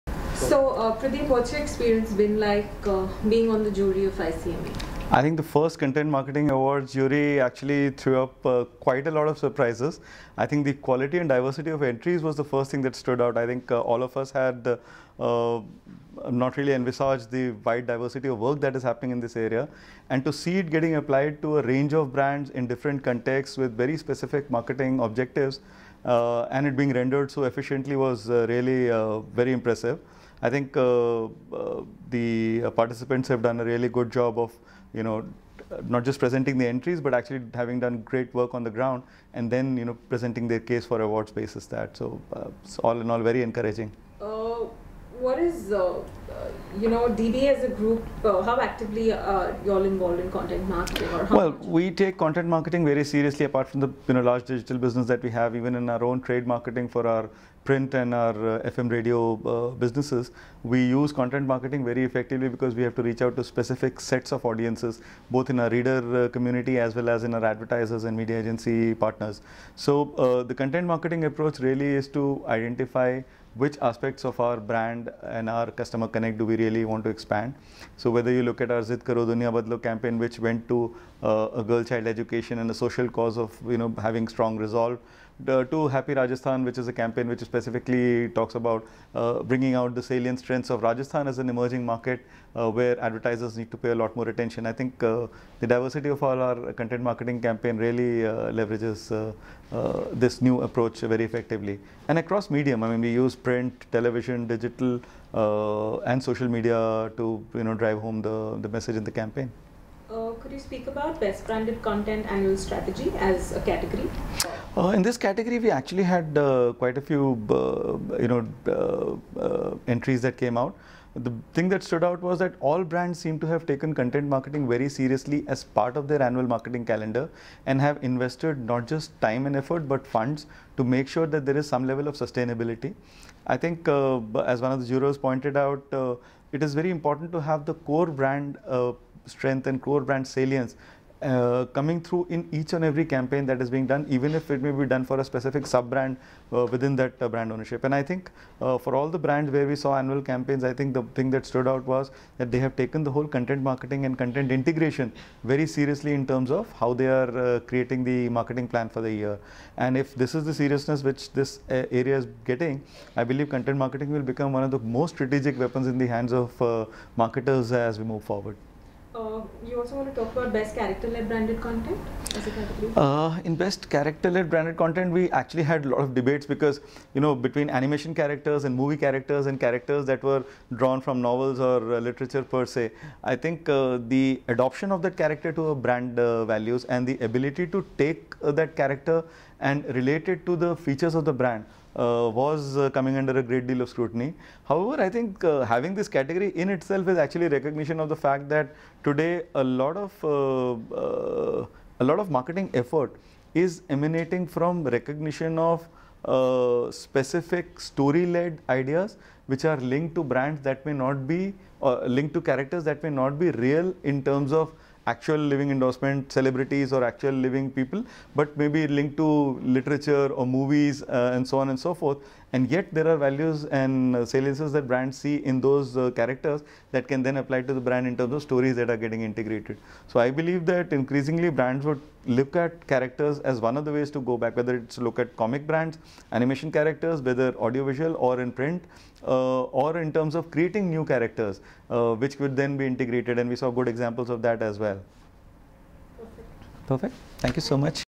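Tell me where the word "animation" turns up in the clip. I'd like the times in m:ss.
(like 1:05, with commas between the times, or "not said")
2:57, 3:56.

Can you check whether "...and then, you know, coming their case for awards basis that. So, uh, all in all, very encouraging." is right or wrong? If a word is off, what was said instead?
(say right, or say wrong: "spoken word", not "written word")
wrong: "presenting", not "coming".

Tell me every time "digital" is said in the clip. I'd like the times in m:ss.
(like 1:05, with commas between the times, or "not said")
0:54, 1:44.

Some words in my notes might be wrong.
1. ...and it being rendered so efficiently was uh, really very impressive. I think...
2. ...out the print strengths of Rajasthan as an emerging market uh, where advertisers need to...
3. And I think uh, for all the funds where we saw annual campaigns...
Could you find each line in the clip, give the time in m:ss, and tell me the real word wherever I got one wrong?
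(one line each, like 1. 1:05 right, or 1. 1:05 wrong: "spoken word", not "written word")
1. 0:26 right
2. 1:29 wrong: "salient", not "print"
3. 2:27 wrong: "brands", not "funds".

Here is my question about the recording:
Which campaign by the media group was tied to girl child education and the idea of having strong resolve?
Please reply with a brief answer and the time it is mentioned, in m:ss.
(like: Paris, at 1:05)
Zid Karo Duniya Badlo, at 1:18.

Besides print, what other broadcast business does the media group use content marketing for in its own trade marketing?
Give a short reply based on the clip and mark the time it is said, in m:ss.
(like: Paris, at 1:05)
FM radio, at 0:58.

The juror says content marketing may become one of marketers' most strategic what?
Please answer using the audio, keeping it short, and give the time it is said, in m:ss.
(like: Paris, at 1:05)
weapons, at 2:45.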